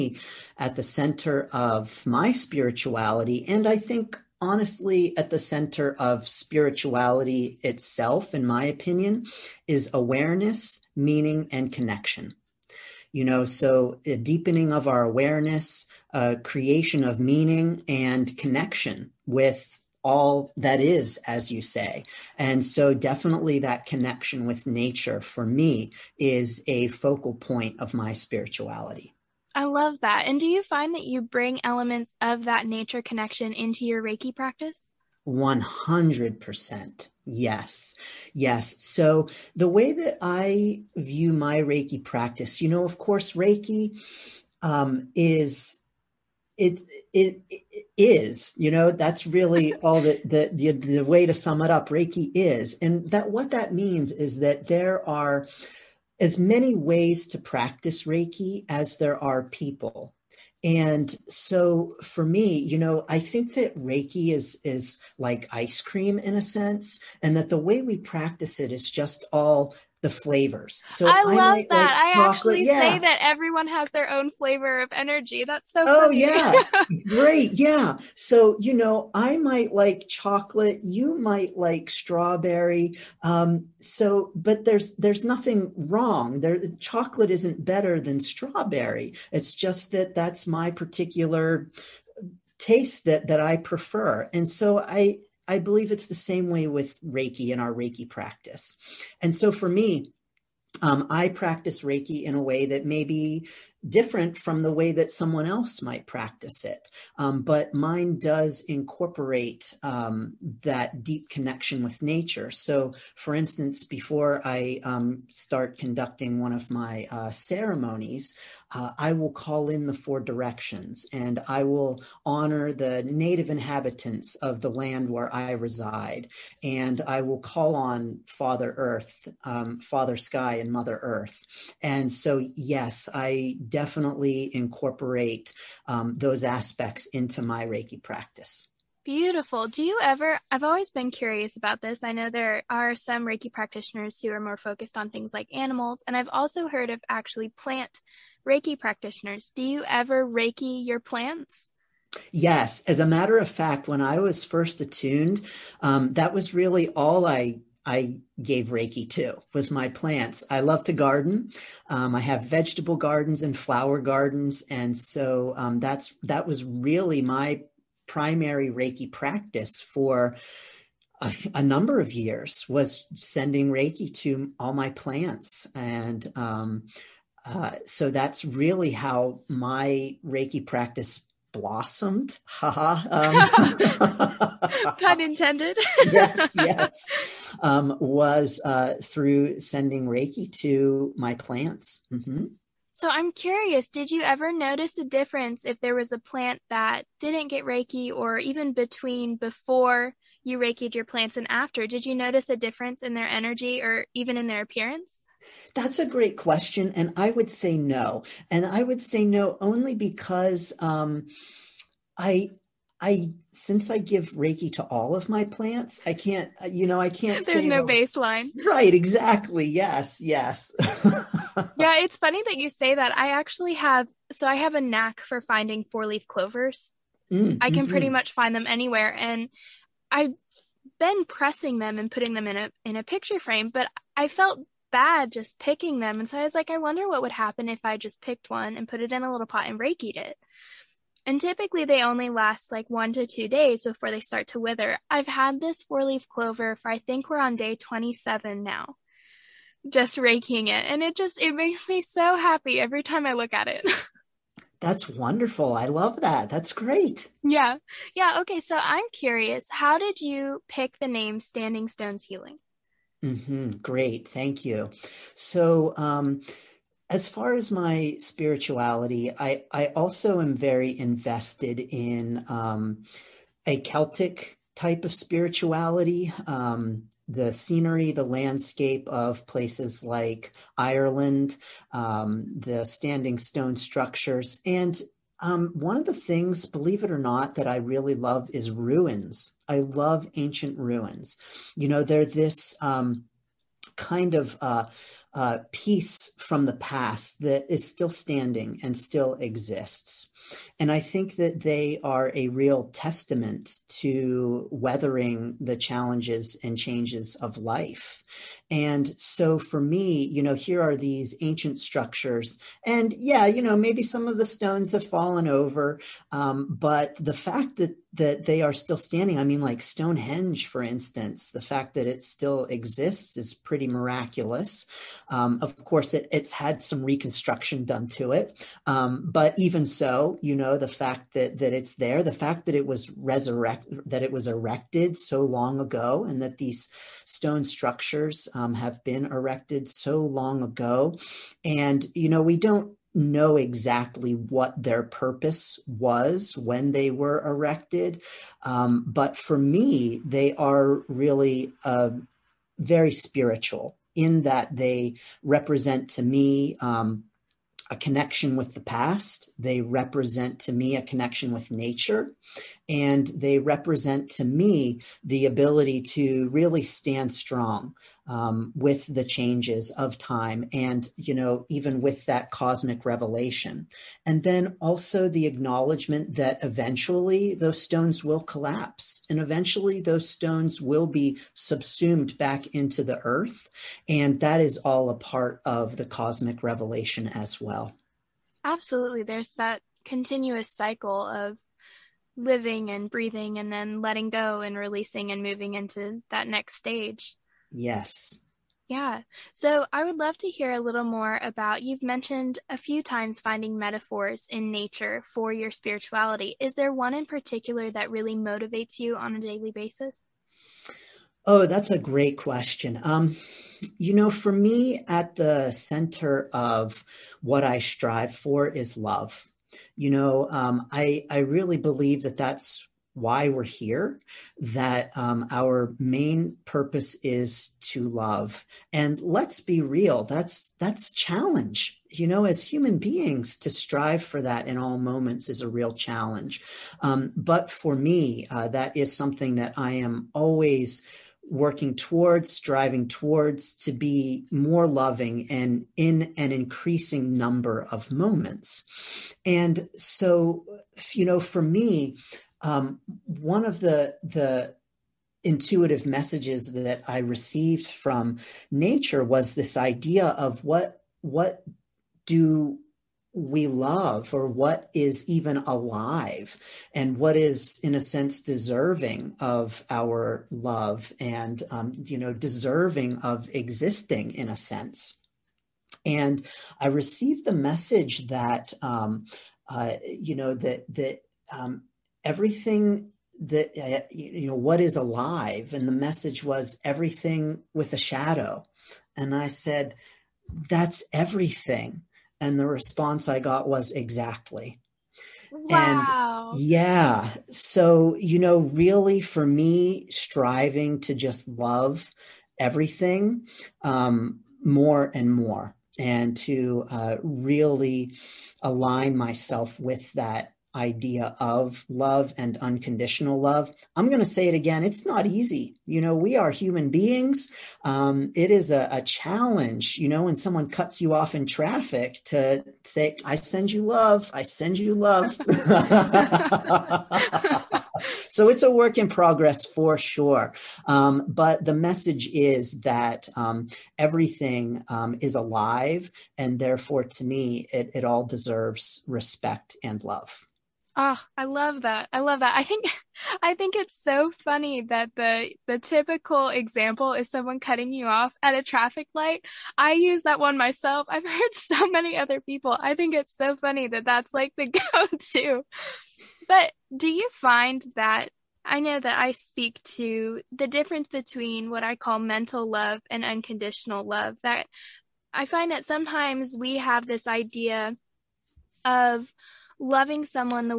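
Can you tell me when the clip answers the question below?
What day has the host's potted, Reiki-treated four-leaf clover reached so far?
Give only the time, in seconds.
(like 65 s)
247 s.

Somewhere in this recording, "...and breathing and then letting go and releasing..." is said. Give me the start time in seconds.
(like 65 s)
392 s.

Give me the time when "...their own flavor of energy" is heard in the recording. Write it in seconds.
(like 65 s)
73 s.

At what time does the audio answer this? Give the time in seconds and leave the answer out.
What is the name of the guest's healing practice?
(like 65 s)
261 s.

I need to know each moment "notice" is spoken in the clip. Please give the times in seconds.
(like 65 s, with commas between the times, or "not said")
194 s, 202 s.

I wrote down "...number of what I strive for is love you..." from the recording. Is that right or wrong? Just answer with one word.
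wrong.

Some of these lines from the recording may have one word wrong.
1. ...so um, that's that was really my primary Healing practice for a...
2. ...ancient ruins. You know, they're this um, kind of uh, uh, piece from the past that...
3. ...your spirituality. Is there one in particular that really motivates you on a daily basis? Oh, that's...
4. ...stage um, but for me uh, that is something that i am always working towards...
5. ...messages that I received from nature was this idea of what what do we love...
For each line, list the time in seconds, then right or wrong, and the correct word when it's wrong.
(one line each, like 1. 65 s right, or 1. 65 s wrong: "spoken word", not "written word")
1. 164 s wrong: "Reiki", not "Healing"
2. 290 s right
3. 405 s right
4. 435 s wrong: "challenge", not "stage"
5. 456 s right.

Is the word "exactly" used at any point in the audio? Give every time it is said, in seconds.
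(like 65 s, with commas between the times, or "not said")
218 s, 343 s, 493 s.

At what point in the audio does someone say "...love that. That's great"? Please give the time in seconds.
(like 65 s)
255 s.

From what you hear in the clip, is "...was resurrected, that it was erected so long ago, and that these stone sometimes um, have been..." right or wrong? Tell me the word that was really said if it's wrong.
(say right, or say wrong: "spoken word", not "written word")
wrong: "structures", not "sometimes".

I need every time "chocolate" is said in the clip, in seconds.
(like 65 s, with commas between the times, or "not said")
80 s, 86 s.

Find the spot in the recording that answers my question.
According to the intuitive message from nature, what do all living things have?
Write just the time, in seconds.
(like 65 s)
487 s.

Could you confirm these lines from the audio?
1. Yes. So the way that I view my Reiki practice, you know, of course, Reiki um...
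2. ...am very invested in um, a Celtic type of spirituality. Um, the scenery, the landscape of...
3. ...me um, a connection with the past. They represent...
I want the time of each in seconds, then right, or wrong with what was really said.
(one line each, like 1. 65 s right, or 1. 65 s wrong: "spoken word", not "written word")
1. 38 s right
2. 270 s right
3. 356 s right.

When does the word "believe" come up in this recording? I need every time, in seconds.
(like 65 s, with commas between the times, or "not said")
95 s, 286 s, 421 s.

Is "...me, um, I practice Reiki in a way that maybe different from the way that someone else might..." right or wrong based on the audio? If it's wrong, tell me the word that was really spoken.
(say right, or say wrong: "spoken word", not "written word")
right.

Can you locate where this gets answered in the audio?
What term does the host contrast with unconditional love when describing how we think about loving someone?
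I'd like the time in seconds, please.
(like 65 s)
562 s.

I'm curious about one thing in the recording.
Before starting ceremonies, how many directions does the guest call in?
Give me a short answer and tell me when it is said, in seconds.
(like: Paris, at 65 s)
4, at 119 s.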